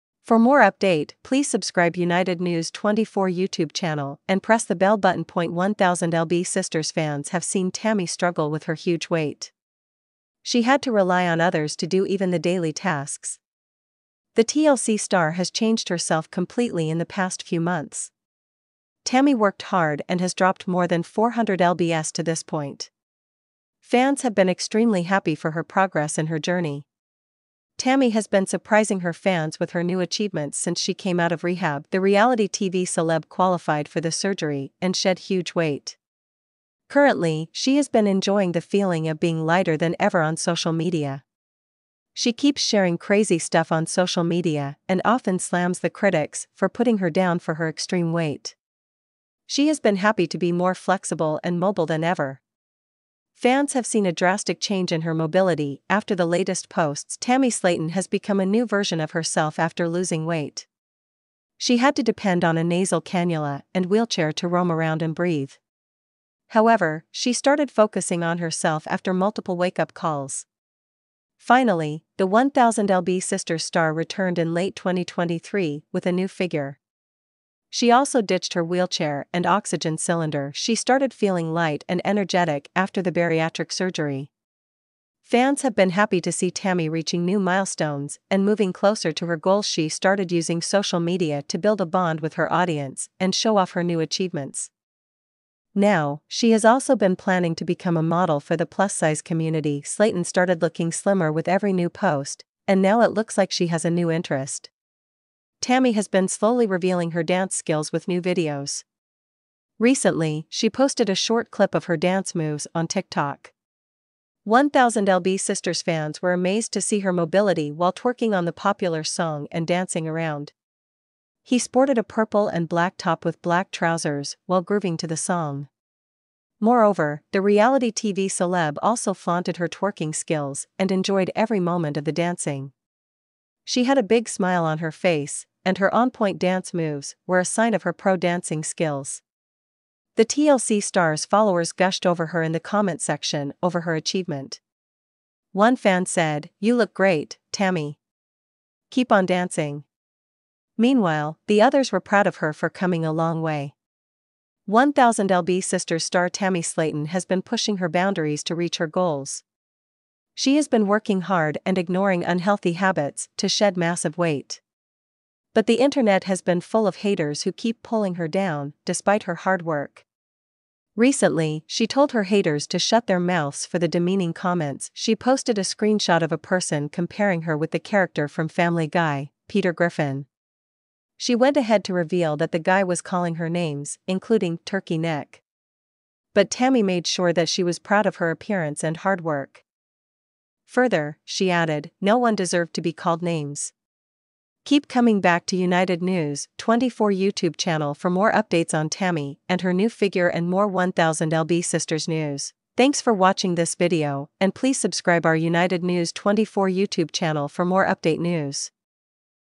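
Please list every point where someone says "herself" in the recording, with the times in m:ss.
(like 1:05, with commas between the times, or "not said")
0:15, 0:59, 1:08.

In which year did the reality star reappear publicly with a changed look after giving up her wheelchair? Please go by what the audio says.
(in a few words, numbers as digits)
2023.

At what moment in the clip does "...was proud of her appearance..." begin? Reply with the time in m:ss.
3:07.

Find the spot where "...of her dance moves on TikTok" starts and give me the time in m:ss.
1:51.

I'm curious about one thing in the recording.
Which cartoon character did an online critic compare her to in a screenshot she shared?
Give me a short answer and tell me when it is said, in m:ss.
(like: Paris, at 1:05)
Peter Griffin, at 2:59.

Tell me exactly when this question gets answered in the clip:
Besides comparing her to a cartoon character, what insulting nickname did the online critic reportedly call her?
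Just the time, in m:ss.
3:04.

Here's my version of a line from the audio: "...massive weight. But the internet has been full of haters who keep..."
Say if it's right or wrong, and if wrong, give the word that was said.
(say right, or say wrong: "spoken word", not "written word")
right.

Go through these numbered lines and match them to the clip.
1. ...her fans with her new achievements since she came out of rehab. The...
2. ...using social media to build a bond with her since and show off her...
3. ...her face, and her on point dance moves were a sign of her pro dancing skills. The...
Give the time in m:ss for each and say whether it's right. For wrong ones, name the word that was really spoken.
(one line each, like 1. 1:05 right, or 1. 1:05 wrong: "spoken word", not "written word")
1. 0:28 right
2. 1:30 wrong: "audience", not "since"
3. 2:14 right.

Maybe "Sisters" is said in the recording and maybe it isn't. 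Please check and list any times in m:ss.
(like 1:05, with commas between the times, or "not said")
0:06, 1:13, 1:55, 2:35, 3:21.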